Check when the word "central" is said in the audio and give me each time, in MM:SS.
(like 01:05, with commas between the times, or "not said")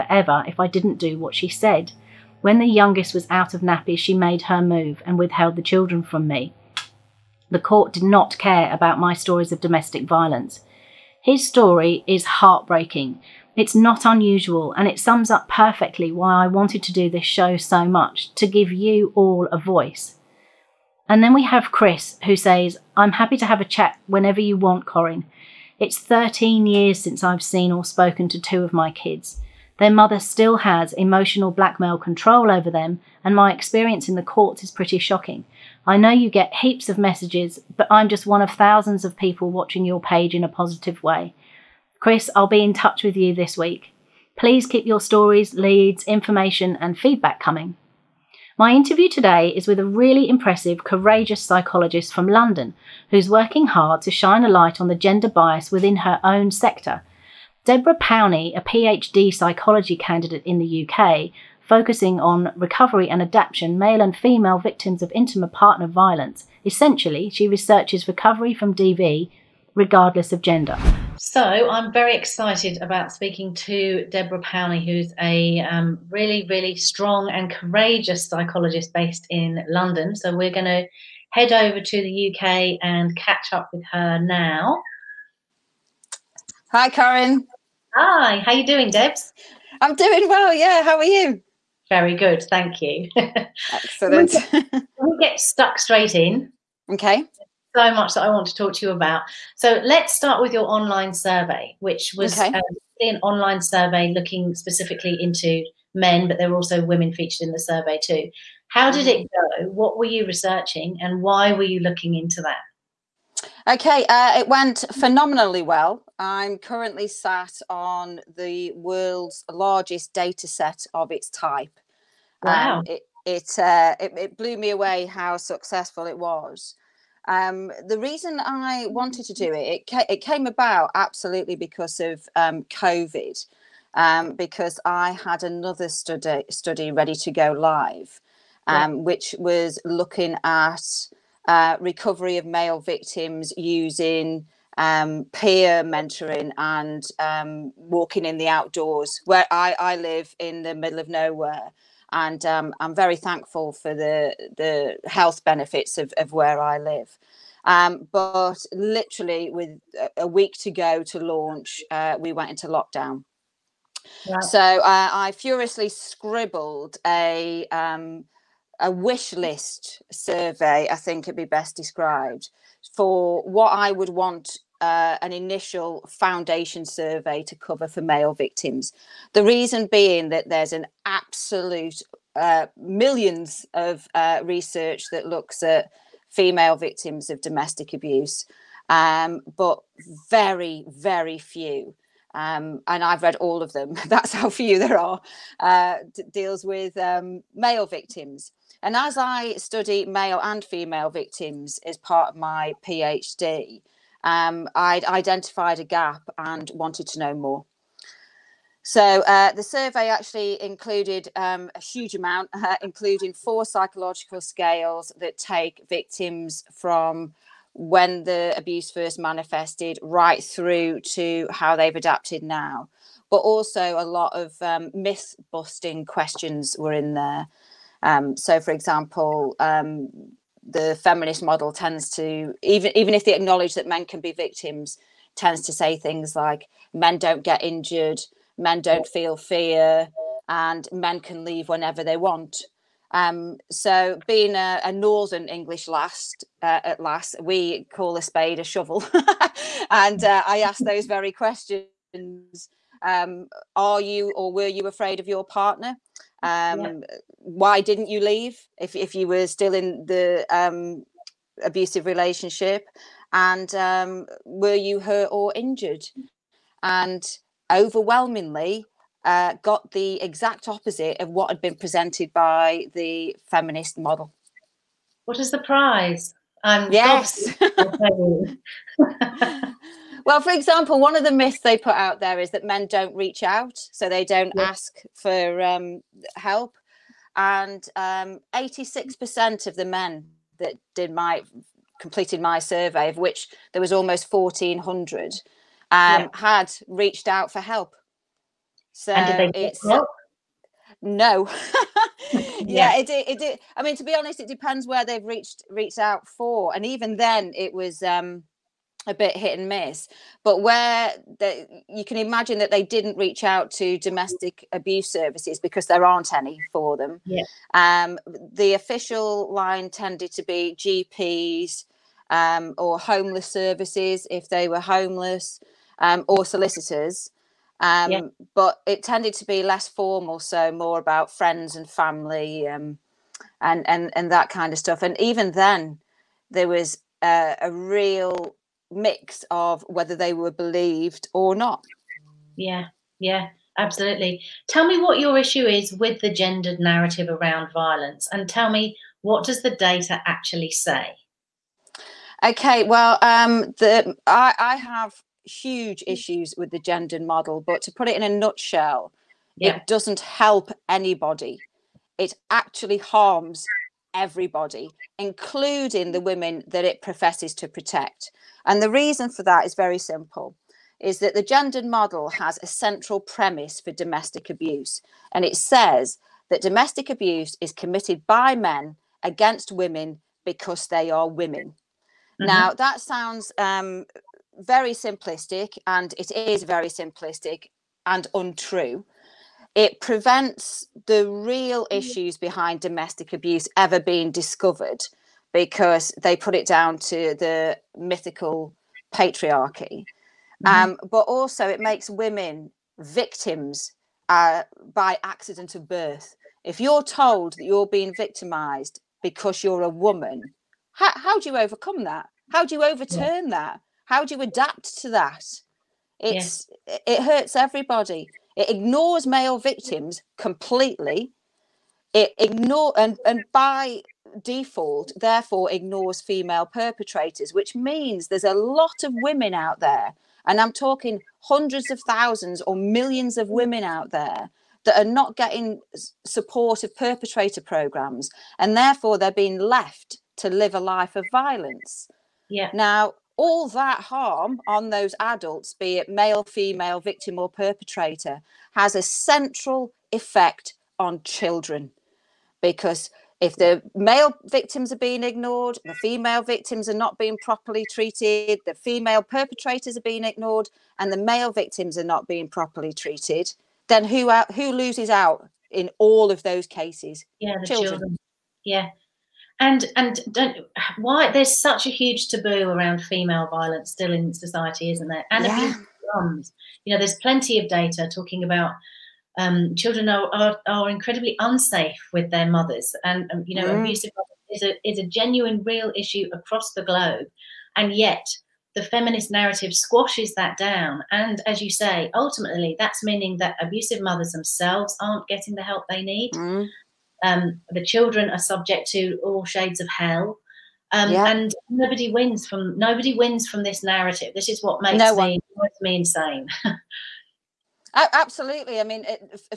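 06:12, 07:29.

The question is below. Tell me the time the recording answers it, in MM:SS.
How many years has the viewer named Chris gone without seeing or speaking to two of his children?
00:25.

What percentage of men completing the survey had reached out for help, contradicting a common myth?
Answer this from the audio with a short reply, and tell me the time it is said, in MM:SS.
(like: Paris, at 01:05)
86%, at 04:48.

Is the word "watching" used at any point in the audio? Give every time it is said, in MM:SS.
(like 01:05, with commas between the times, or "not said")
00:39.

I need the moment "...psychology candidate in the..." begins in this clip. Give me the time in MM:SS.
00:59.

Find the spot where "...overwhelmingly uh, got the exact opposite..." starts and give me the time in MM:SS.
04:27.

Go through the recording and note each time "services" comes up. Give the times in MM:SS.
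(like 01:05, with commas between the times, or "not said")
05:15, 05:23.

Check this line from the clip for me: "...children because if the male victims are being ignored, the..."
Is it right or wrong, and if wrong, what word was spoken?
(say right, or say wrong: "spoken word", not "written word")
right.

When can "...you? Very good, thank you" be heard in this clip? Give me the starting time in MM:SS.
01:31.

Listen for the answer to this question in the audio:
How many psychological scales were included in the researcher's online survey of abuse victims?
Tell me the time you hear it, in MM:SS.
03:33.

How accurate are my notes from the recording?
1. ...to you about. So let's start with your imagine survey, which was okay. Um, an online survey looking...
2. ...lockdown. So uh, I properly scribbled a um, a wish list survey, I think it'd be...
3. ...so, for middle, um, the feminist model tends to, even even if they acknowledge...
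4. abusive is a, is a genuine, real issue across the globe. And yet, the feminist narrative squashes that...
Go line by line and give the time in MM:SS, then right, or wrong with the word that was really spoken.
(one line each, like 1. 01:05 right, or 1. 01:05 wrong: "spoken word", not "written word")
1. 01:38 wrong: "online", not "imagine"
2. 02:42 wrong: "furiously", not "properly"
3. 03:48 wrong: "example", not "middle"
4. 08:03 right.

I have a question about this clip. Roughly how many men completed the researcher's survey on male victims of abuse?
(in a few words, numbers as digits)
1,400.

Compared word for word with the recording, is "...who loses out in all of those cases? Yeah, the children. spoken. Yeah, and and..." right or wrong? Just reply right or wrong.
wrong.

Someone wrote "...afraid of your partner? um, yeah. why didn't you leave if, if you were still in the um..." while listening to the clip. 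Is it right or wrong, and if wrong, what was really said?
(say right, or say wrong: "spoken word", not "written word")
right.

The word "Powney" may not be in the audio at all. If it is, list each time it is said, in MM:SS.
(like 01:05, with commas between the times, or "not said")
00:57, 01:14.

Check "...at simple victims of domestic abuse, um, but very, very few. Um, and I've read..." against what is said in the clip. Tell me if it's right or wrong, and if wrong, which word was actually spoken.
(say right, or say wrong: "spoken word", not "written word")
wrong: "female", not "simple".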